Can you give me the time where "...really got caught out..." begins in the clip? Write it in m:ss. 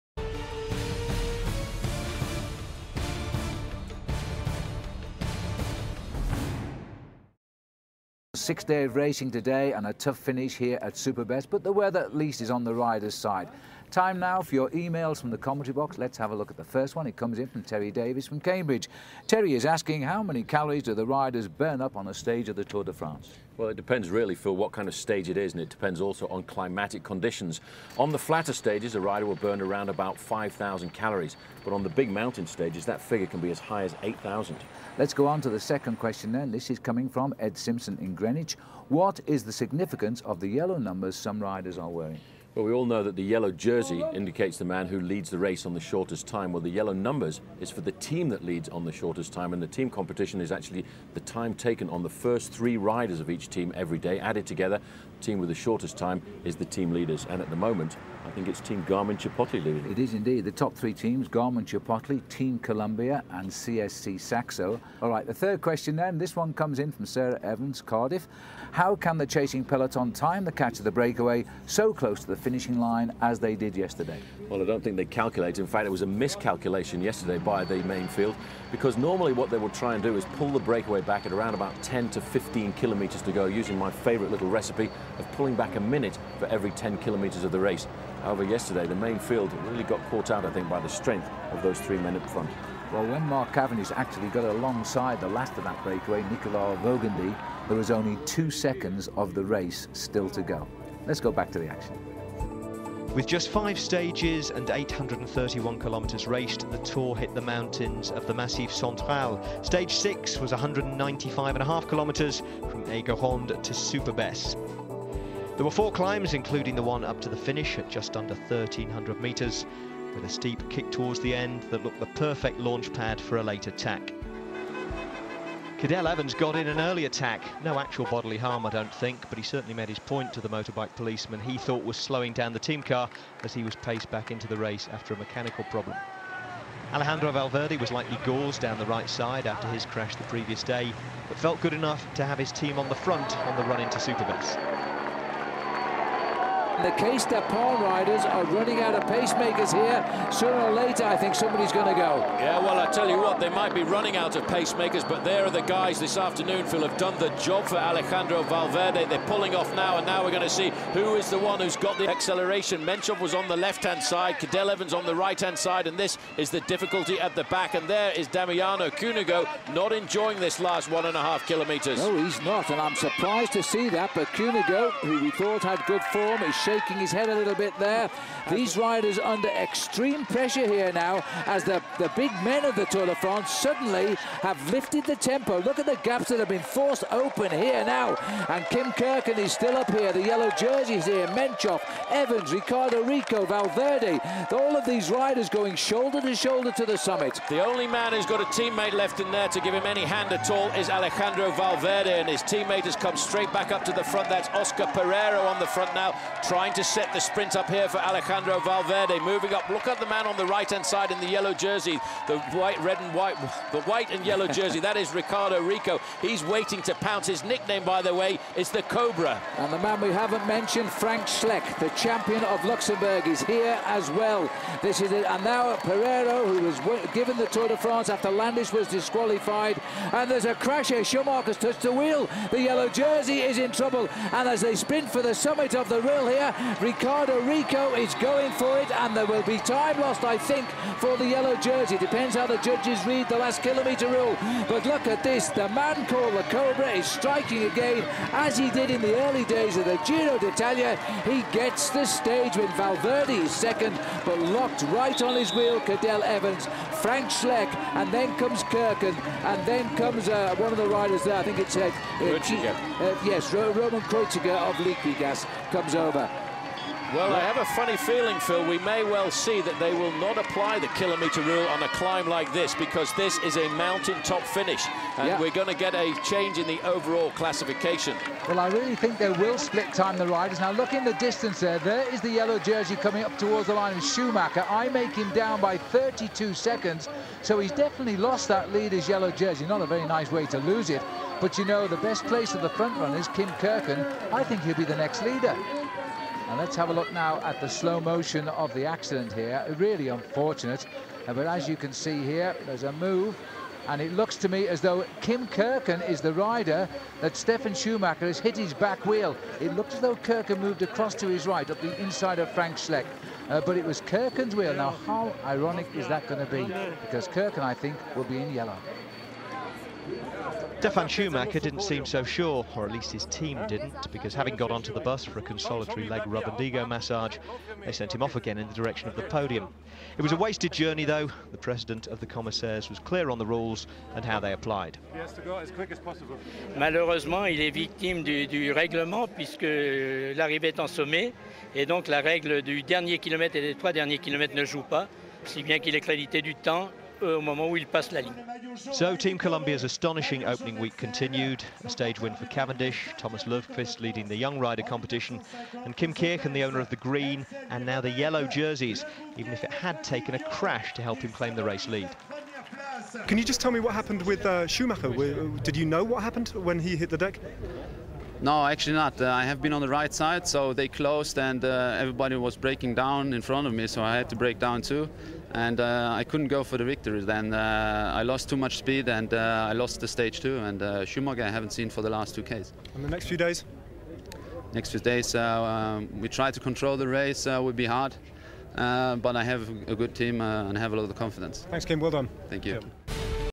1:29.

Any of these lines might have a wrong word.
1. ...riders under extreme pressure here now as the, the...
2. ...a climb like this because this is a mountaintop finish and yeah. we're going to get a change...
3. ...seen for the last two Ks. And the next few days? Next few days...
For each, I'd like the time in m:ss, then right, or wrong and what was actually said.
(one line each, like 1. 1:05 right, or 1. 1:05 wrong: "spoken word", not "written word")
1. 2:58 right
2. 4:31 right
3. 6:21 right.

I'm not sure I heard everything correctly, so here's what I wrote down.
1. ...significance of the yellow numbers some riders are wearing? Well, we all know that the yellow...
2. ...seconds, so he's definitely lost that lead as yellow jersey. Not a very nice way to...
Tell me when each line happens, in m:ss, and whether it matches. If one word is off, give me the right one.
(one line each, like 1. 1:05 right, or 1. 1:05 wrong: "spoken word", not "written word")
1. 0:39 right
2. 4:46 right.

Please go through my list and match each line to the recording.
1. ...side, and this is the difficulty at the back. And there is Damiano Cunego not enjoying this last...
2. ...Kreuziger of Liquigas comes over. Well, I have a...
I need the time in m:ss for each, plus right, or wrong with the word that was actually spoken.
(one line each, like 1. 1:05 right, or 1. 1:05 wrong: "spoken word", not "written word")
1. 2:45 right
2. 4:24 right.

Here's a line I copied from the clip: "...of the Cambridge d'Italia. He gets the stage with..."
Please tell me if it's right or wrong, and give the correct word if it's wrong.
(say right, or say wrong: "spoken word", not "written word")
wrong: "Giro", not "Cambridge".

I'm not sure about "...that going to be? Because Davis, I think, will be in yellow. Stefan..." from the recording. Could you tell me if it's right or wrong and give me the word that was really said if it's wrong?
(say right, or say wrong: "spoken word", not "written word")
wrong: "Kirchen", not "Davis".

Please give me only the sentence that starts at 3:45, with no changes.
And now Pereiro, who was given the Tour de France after Landis was disqualified.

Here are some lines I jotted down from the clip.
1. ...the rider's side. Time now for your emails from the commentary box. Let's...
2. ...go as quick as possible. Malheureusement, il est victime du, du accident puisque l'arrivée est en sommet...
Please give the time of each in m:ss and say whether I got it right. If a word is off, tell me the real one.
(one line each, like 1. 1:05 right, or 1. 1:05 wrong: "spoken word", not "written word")
1. 0:12 right
2. 5:35 wrong: "règlement", not "accident".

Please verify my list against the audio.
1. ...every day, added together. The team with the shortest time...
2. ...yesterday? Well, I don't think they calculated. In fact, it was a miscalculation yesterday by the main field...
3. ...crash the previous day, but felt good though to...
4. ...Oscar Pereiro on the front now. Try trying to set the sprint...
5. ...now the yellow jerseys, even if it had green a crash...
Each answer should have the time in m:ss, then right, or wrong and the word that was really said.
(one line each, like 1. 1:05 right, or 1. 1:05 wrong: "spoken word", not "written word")
1. 0:53 right
2. 1:13 right
3. 2:19 wrong: "enough", not "though"
4. 3:24 right
5. 5:57 wrong: "taken", not "green".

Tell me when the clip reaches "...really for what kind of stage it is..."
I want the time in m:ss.
0:24.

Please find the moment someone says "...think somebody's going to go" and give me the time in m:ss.
2:31.